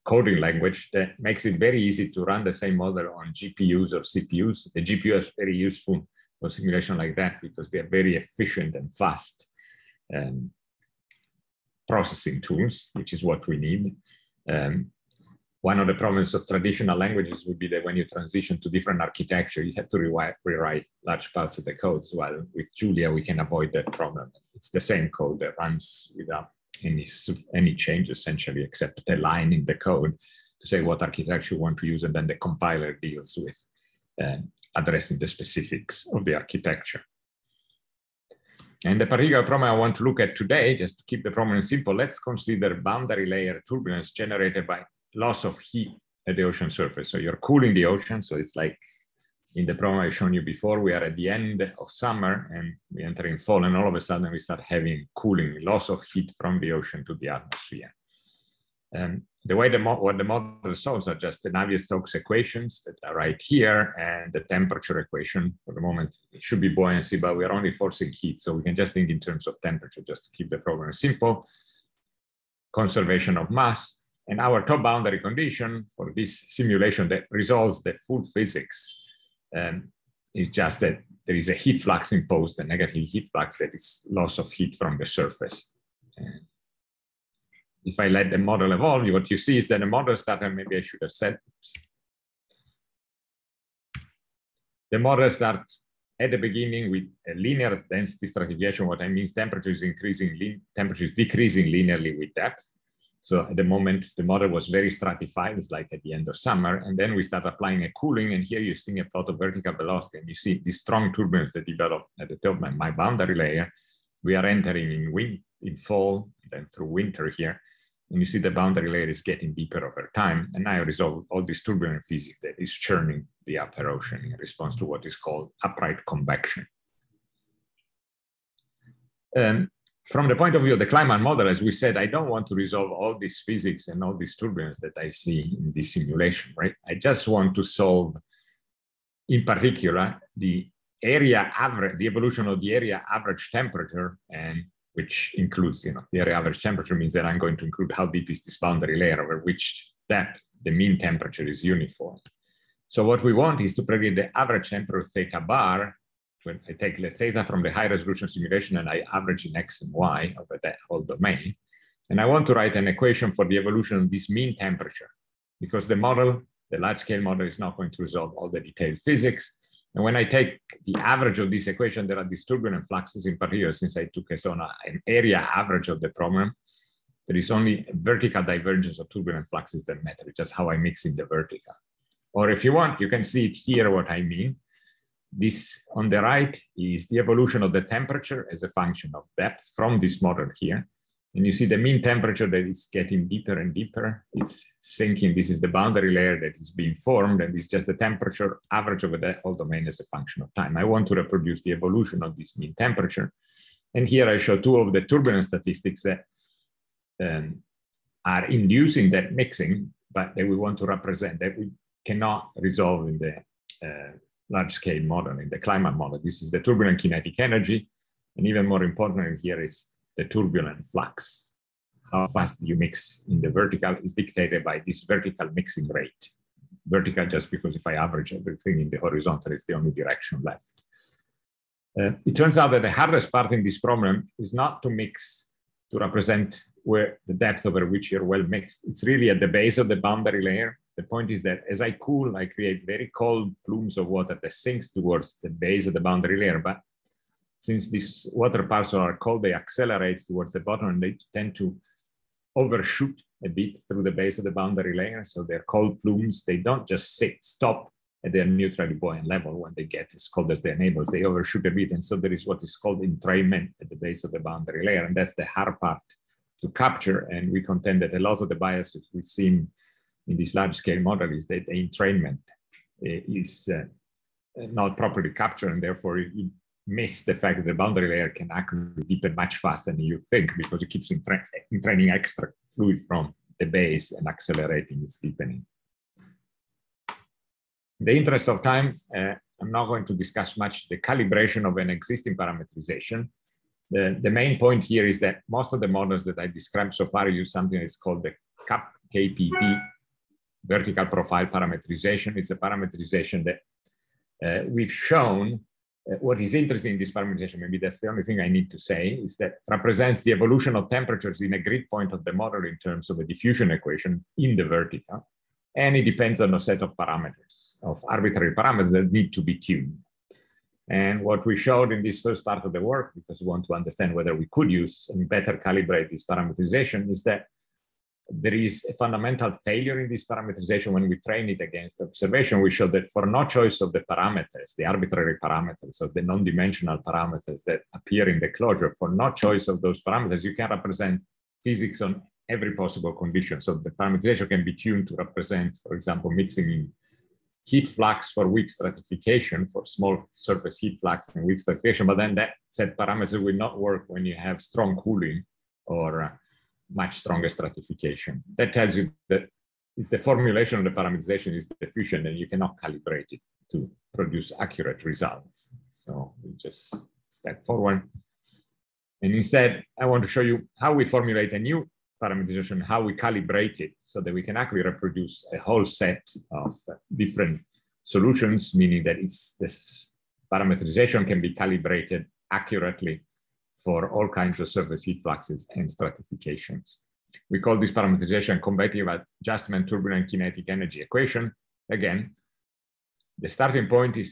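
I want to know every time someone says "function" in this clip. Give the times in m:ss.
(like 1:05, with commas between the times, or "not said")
3:08, 3:20.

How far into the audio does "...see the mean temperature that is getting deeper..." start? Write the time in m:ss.
3:11.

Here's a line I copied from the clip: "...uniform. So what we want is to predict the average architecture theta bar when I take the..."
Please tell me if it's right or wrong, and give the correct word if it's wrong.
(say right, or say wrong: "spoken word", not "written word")
wrong: "temperature", not "architecture".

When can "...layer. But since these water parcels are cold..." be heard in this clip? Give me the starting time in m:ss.
4:06.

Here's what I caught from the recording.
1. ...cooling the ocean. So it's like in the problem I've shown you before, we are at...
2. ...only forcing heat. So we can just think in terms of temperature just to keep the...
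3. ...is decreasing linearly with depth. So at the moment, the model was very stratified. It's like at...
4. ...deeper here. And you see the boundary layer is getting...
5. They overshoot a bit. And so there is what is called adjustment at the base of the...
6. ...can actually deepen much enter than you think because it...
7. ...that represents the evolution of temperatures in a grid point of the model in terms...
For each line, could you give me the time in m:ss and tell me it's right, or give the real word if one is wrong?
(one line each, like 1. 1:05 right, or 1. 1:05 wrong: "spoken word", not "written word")
1. 0:47 right
2. 1:07 right
3. 1:41 right
4. 1:56 wrong: "winter", not "deeper"
5. 4:21 wrong: "entrainment", not "adjustment"
6. 4:38 wrong: "faster", not "enter"
7. 5:09 right.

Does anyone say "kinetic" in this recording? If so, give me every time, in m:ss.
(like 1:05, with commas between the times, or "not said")
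3:37, 6:30.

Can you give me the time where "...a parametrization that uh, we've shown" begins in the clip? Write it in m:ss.
5:02.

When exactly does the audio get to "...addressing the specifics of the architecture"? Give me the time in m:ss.
0:34.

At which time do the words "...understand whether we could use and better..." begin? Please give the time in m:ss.
5:23.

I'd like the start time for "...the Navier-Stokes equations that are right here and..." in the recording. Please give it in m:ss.
1:01.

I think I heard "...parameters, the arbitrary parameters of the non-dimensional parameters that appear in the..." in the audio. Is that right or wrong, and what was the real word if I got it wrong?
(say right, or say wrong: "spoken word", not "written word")
right.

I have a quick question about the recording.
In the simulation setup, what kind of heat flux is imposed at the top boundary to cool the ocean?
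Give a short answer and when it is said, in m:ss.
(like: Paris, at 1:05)
A negative heat flux, at 1:22.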